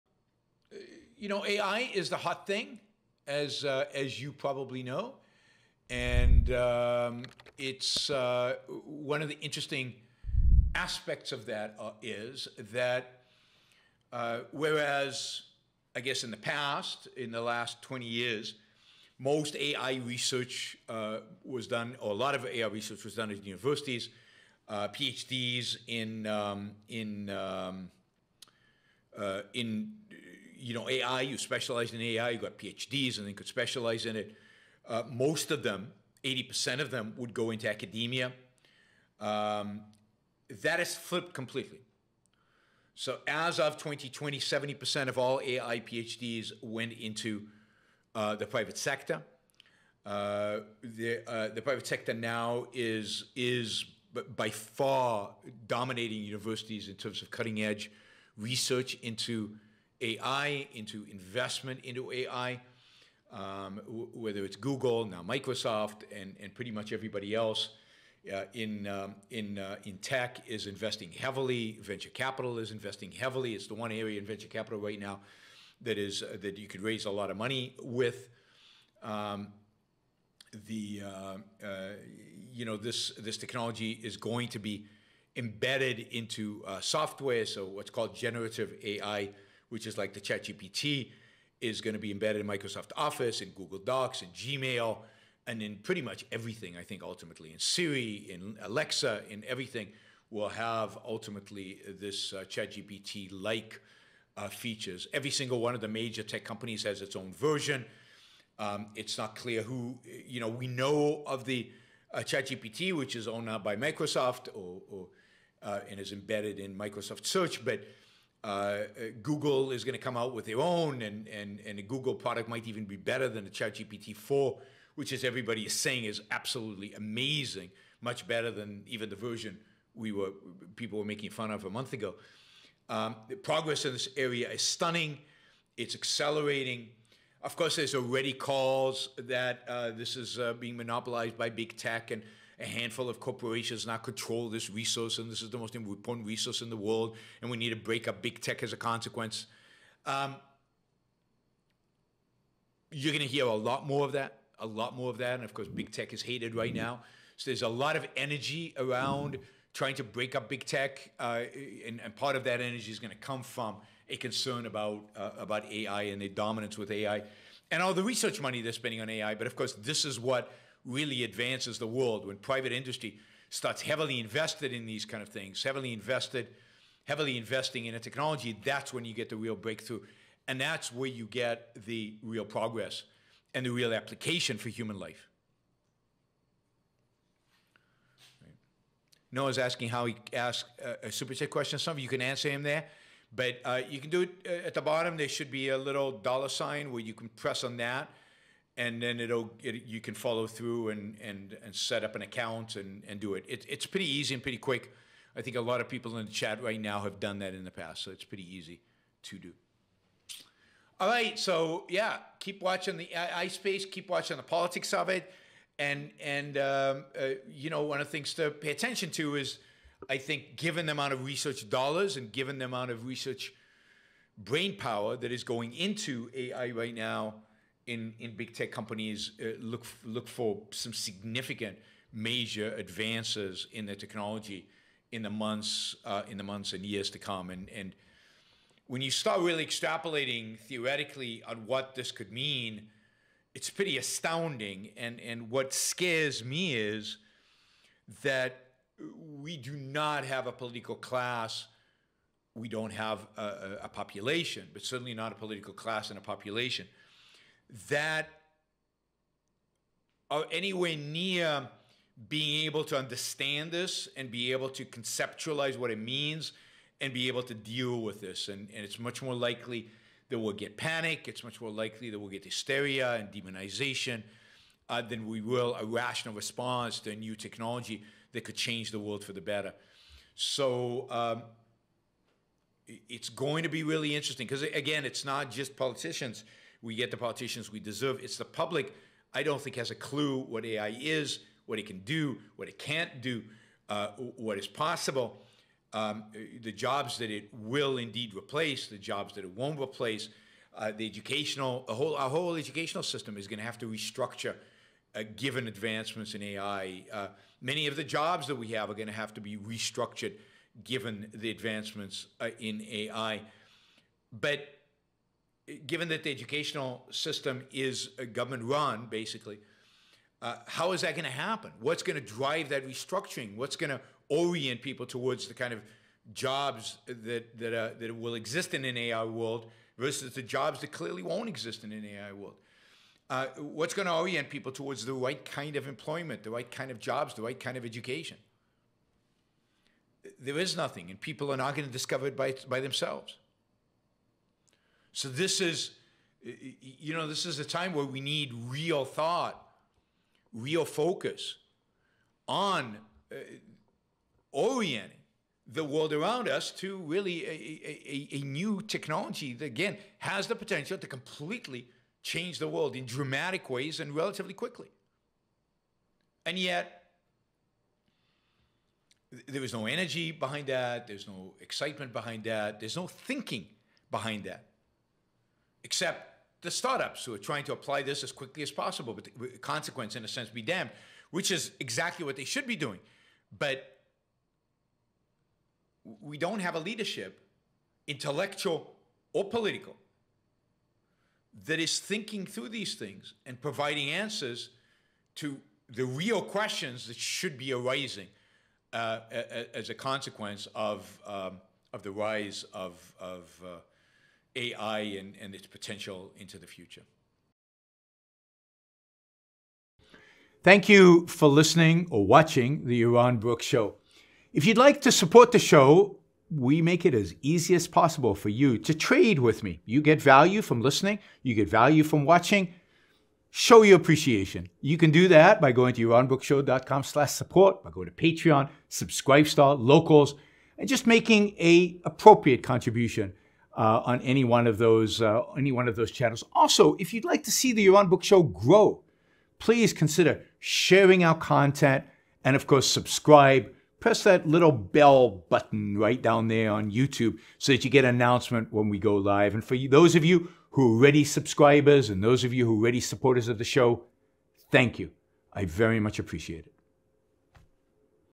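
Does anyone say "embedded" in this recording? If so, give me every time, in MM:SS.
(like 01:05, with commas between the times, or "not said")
01:25, 01:32, 01:56.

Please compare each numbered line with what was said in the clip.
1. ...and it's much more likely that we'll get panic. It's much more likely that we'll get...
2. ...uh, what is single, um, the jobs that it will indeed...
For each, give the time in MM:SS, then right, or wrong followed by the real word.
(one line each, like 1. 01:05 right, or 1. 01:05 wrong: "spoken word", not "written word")
1. 04:28 right
2. 04:53 wrong: "possible", not "single".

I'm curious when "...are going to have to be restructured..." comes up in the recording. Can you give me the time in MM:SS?
05:08.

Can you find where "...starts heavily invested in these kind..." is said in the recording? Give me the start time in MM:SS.
02:53.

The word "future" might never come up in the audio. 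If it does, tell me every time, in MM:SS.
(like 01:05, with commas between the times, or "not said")
06:46.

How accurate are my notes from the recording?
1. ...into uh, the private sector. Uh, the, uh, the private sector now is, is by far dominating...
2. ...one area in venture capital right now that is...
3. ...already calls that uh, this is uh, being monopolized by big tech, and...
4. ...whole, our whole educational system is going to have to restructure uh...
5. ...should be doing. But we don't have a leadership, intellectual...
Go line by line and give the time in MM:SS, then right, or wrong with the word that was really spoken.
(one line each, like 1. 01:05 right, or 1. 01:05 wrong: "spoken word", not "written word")
1. 00:46 right
2. 01:13 right
3. 02:17 right
4. 05:01 right
5. 06:22 right.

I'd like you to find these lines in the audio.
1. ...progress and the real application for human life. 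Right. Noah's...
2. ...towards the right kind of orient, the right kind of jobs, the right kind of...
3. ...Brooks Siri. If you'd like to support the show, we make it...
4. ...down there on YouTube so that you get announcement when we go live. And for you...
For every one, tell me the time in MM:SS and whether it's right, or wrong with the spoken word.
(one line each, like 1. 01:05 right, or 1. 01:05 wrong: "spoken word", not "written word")
1. 03:02 right
2. 05:34 wrong: "employment", not "orient"
3. 06:53 wrong: "Show", not "Siri"
4. 07:26 right.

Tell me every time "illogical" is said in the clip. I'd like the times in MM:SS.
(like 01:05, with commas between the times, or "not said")
not said.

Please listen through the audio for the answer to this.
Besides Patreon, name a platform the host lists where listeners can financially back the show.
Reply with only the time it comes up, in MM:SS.
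07:08.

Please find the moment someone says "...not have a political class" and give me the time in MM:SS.
04:09.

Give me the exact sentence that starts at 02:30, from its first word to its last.
Um, you're going to hear a lot more of that, a lot more of that.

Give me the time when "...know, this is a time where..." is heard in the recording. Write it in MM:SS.
05:47.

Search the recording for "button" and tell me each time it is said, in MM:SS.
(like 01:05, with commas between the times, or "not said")
07:25.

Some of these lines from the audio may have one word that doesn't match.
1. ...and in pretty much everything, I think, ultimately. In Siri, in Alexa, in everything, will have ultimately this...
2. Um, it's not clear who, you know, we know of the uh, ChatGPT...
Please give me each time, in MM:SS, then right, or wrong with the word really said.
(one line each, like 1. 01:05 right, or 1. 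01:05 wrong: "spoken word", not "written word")
1. 01:35 right
2. 01:48 right.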